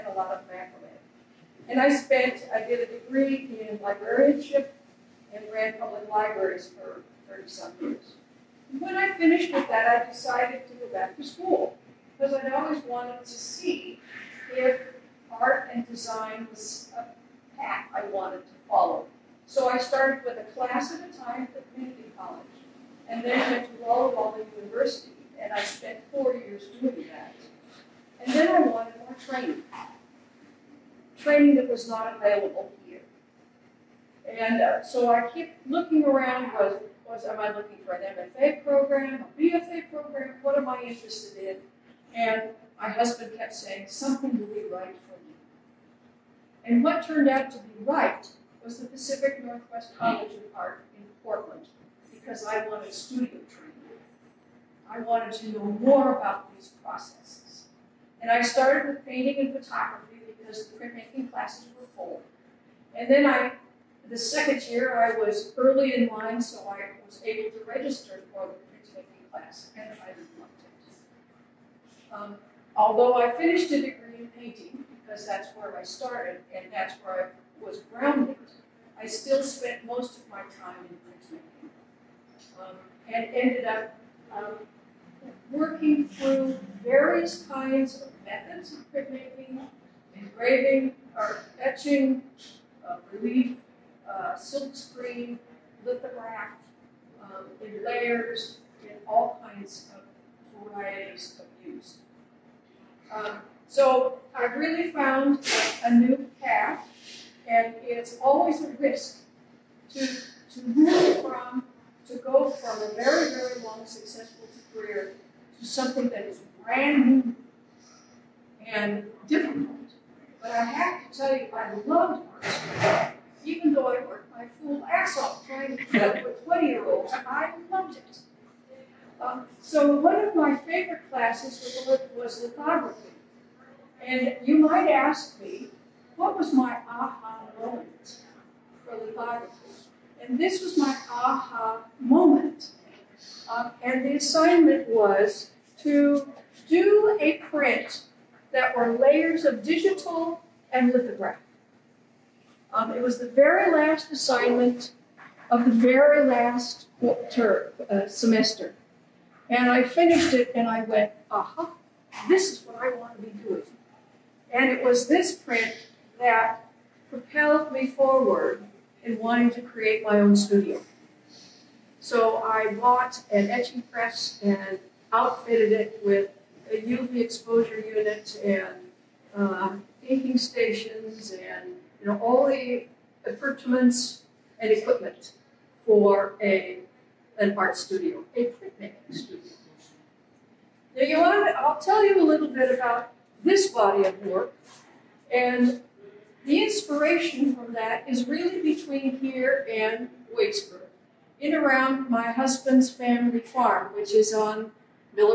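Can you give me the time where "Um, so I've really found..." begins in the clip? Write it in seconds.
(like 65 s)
103 s.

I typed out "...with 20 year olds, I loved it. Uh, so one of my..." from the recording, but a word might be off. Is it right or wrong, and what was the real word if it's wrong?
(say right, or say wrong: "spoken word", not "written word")
right.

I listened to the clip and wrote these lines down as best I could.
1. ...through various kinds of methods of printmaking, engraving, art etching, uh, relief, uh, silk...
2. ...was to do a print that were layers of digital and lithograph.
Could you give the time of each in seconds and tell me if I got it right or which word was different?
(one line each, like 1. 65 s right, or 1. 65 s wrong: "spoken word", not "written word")
1. 86 s right
2. 144 s right.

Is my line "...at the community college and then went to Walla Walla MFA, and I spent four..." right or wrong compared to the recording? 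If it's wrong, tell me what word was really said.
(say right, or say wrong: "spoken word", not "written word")
wrong: "University", not "MFA".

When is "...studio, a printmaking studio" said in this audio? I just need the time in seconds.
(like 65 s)
187 s.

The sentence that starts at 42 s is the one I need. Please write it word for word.
And my husband kept saying, something will be right for you.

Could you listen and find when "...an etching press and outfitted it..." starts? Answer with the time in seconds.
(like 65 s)
173 s.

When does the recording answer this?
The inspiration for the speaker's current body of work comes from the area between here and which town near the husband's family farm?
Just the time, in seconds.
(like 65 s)
200 s.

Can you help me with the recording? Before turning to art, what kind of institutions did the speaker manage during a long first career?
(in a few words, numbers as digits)
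Public libraries.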